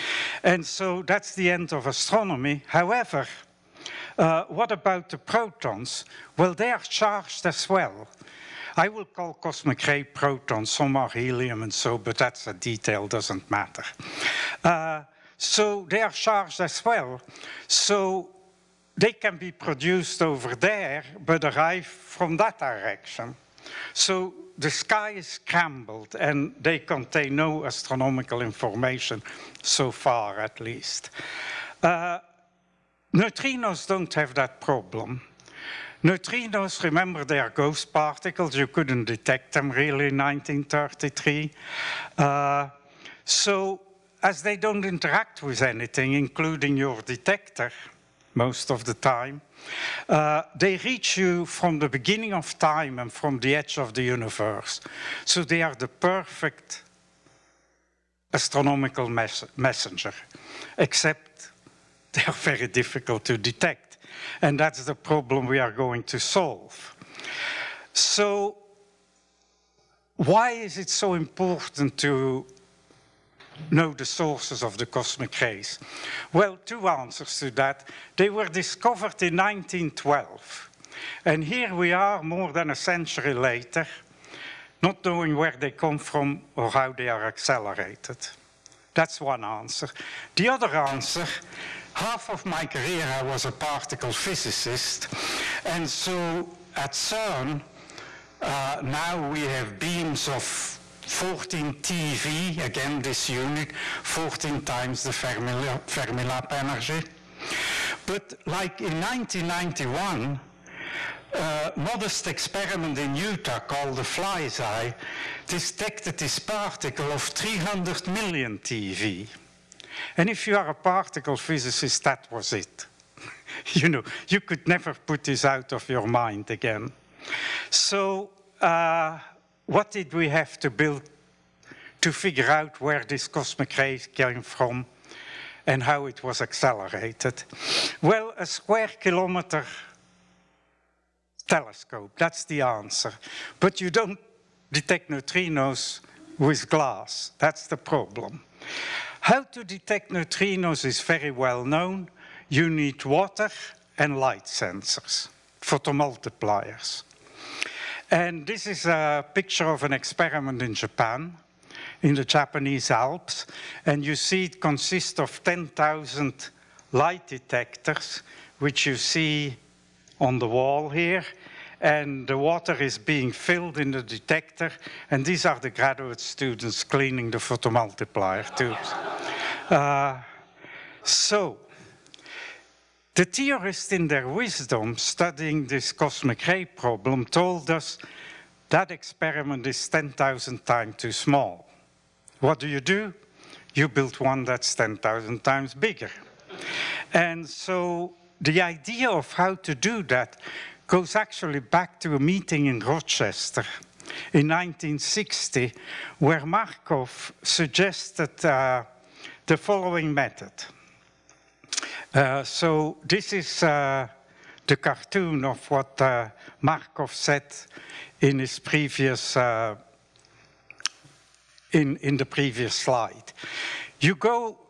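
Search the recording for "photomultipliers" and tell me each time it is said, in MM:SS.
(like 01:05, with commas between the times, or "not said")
02:35, 02:57.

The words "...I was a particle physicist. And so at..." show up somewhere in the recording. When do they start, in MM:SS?
01:33.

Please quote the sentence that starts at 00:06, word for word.
Well, they are charged as well.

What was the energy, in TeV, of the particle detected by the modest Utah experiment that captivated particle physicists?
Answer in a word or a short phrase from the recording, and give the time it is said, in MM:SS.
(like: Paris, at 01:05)
300 million TeV, at 01:57.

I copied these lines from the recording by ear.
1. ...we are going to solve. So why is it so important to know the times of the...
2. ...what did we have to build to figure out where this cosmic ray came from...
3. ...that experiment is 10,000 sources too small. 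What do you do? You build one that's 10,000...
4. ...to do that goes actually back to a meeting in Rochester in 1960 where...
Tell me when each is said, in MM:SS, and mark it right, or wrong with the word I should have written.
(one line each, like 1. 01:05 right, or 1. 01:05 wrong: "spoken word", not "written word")
1. 01:05 wrong: "sources", not "times"
2. 02:09 right
3. 03:08 wrong: "times", not "sources"
4. 03:19 right.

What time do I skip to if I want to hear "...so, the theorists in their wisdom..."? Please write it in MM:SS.
03:01.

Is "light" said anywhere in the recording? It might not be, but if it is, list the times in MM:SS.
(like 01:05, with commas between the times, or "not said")
02:34, 02:46.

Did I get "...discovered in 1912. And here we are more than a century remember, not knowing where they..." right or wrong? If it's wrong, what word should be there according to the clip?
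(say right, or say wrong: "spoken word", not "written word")
wrong: "later", not "remember".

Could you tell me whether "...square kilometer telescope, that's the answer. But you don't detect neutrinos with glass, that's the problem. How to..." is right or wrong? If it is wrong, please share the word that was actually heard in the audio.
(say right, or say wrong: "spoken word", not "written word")
right.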